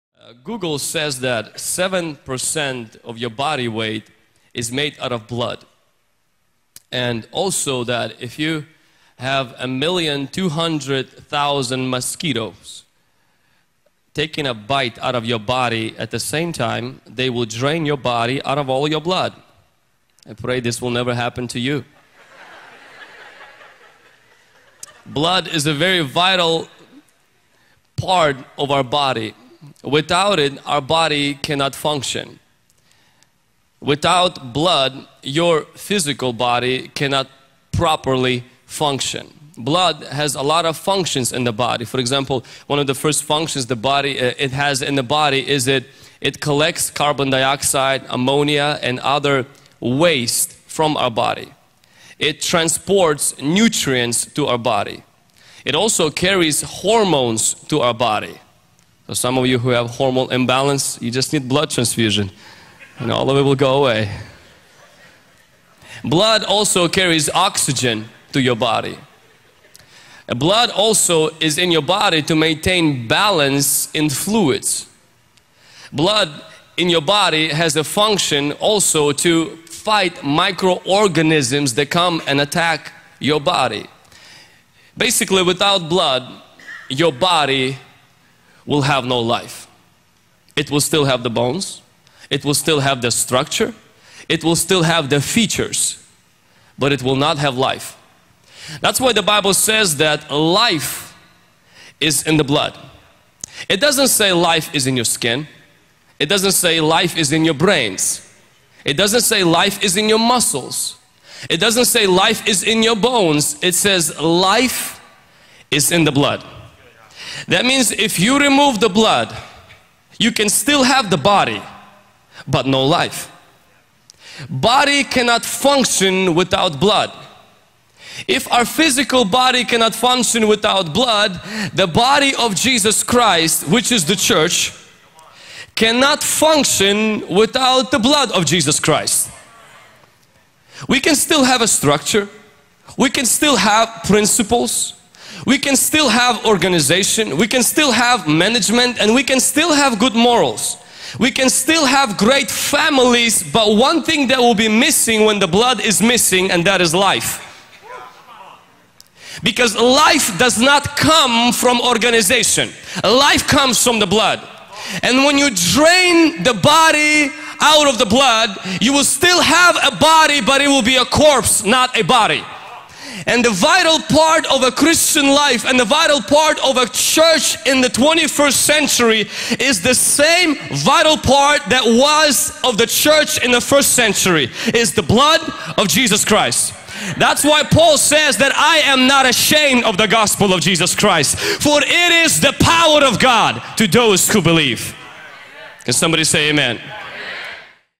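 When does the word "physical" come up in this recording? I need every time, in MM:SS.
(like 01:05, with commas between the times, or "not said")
00:35, 02:08.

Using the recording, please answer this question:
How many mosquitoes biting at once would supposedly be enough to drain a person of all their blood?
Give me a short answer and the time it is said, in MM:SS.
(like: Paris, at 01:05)
1,200,000, at 00:09.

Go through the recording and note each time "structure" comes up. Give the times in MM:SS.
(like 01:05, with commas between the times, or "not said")
01:33, 02:21.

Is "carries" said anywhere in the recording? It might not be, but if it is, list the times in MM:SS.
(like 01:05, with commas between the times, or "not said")
00:56, 01:06.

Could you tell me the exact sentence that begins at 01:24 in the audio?
Basically, without blood, your body will have no life.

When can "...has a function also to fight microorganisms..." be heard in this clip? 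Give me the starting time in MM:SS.
01:17.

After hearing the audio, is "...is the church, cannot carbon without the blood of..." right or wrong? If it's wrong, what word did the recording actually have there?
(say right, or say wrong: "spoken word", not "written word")
wrong: "function", not "carbon".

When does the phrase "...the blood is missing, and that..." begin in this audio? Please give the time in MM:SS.
02:35.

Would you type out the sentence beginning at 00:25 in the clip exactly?
blood is a very vital part of our body.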